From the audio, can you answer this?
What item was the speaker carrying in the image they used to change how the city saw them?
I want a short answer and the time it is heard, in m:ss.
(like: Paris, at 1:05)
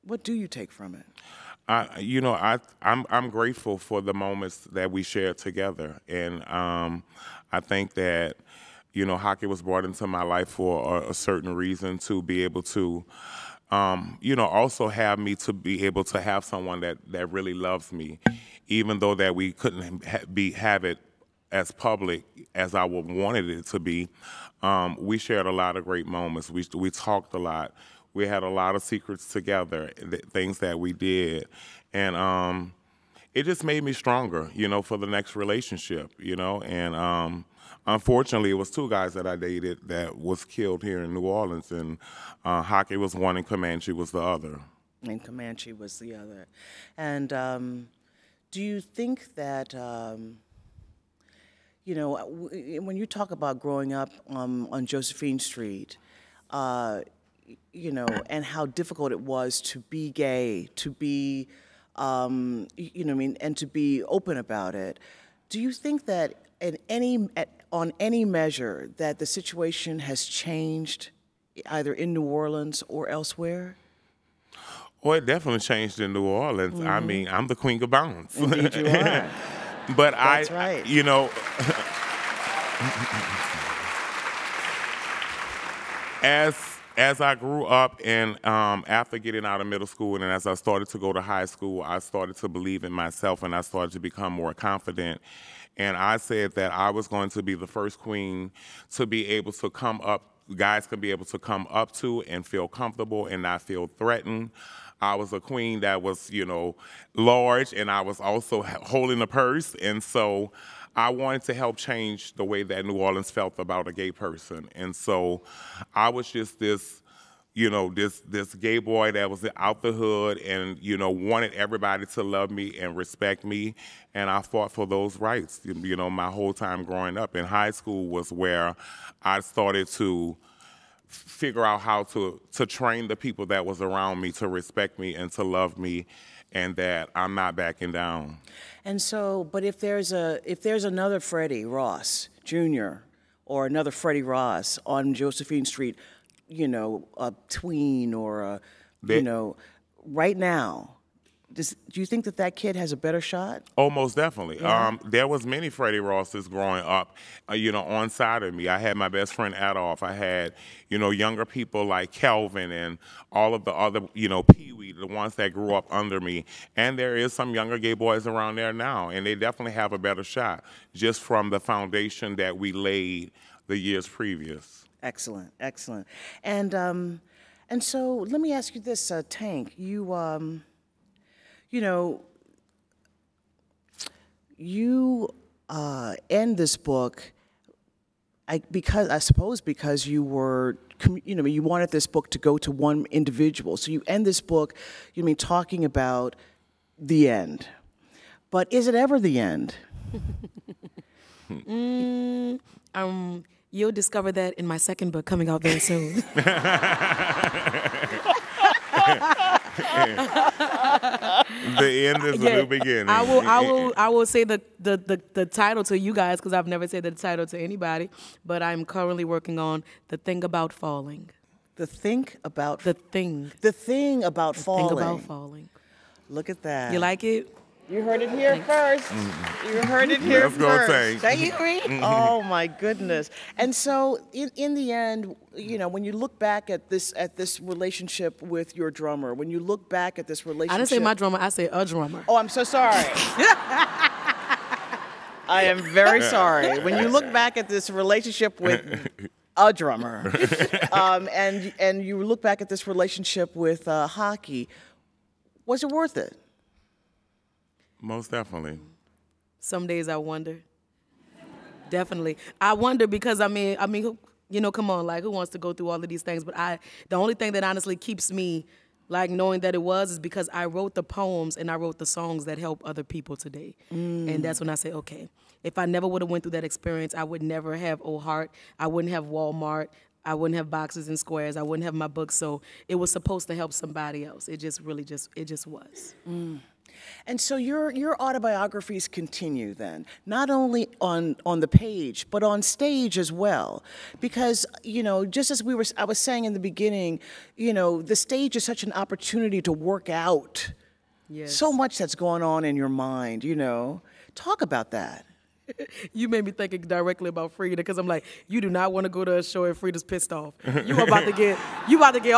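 A purse, at 1:49.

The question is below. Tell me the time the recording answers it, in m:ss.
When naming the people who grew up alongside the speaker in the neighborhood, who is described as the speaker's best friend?
2:39.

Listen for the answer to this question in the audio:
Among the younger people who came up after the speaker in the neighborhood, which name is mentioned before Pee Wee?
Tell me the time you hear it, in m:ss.
2:42.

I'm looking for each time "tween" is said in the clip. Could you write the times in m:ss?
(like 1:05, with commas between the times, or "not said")
2:27.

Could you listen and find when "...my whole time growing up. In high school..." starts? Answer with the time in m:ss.
2:06.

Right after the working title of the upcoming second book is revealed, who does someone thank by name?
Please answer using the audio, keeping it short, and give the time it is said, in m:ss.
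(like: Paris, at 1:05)
Reed, at 3:51.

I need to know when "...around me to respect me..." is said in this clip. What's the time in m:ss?
2:13.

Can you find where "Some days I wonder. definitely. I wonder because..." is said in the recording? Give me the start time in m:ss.
4:19.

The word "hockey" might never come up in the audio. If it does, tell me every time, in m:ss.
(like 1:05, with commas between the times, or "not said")
0:09, 0:42, 4:14.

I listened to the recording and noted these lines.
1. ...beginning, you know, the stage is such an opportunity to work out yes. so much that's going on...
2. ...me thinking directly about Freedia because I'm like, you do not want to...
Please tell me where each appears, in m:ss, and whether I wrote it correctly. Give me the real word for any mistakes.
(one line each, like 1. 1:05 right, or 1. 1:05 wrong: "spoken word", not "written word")
1. 4:56 right
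2. 5:06 right.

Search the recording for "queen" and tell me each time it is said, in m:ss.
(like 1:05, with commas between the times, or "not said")
1:17, 1:37, 1:45.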